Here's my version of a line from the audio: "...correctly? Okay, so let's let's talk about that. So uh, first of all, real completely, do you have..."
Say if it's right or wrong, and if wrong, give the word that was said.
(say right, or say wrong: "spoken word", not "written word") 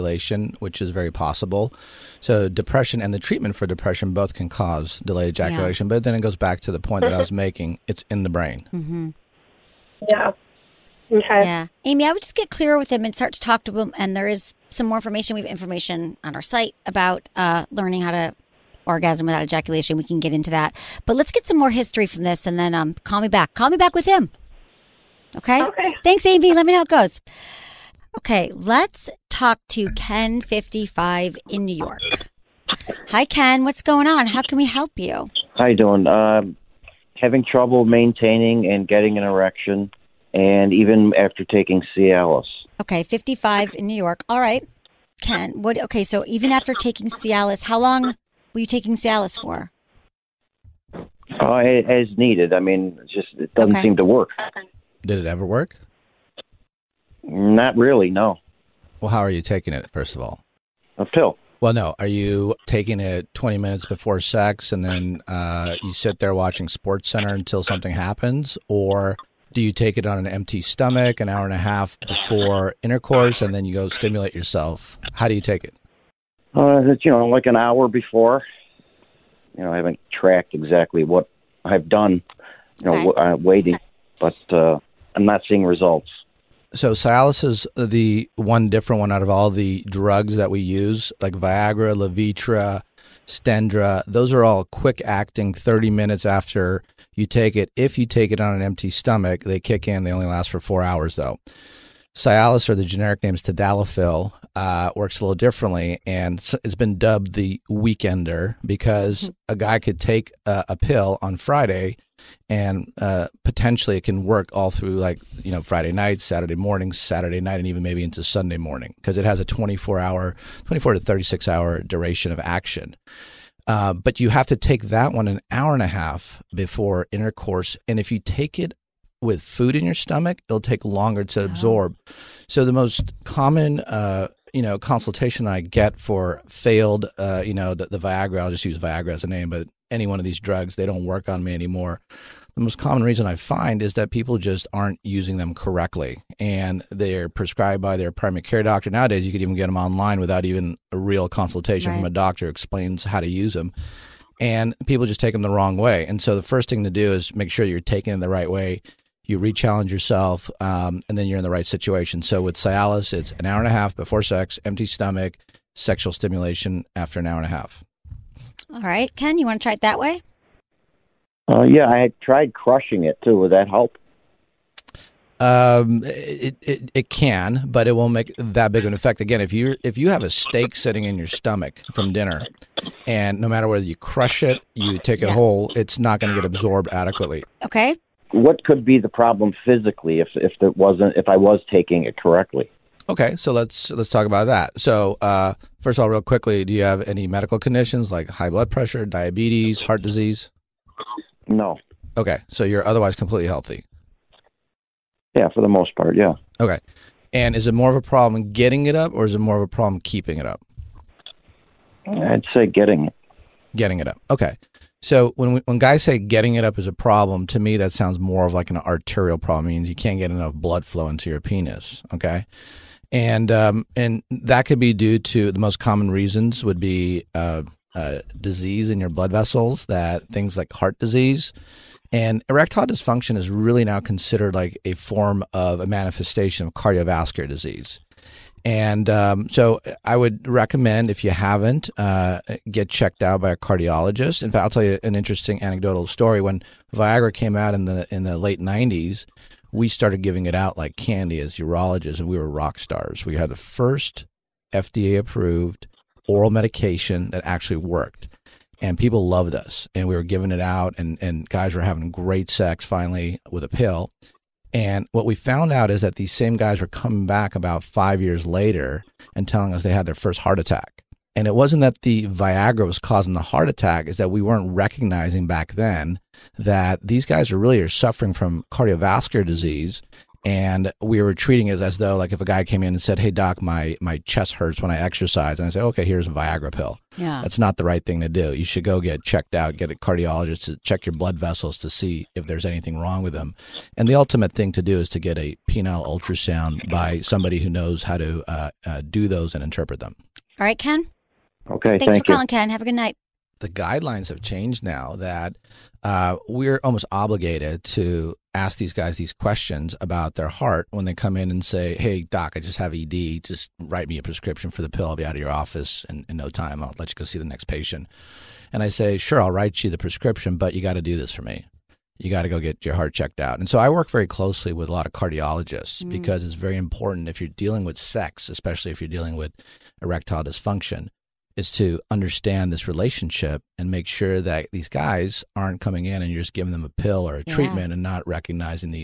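wrong: "quickly", not "completely".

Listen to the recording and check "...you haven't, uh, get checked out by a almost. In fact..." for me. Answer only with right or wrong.
wrong.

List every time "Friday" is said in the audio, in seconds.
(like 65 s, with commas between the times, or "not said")
111 s, 115 s.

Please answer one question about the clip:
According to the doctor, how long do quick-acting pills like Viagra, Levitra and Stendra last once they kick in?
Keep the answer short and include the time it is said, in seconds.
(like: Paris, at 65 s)
4 hours, at 100 s.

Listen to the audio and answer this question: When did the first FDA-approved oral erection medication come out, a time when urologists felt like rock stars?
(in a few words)
late '90s.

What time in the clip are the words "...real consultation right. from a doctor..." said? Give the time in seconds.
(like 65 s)
150 s.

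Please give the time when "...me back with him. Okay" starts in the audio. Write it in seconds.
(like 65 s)
23 s.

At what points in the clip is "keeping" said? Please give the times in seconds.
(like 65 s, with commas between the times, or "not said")
210 s.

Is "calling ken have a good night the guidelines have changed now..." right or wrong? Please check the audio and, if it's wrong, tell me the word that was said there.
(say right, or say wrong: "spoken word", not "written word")
right.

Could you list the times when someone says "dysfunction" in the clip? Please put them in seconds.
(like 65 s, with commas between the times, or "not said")
232 s, 330 s.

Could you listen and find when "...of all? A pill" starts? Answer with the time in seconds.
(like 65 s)
60 s.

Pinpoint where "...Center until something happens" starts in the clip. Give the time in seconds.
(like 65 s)
67 s.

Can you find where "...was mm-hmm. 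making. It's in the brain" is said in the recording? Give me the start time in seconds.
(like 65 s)
7 s.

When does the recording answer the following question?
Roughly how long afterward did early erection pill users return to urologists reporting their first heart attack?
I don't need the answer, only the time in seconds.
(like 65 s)
267 s.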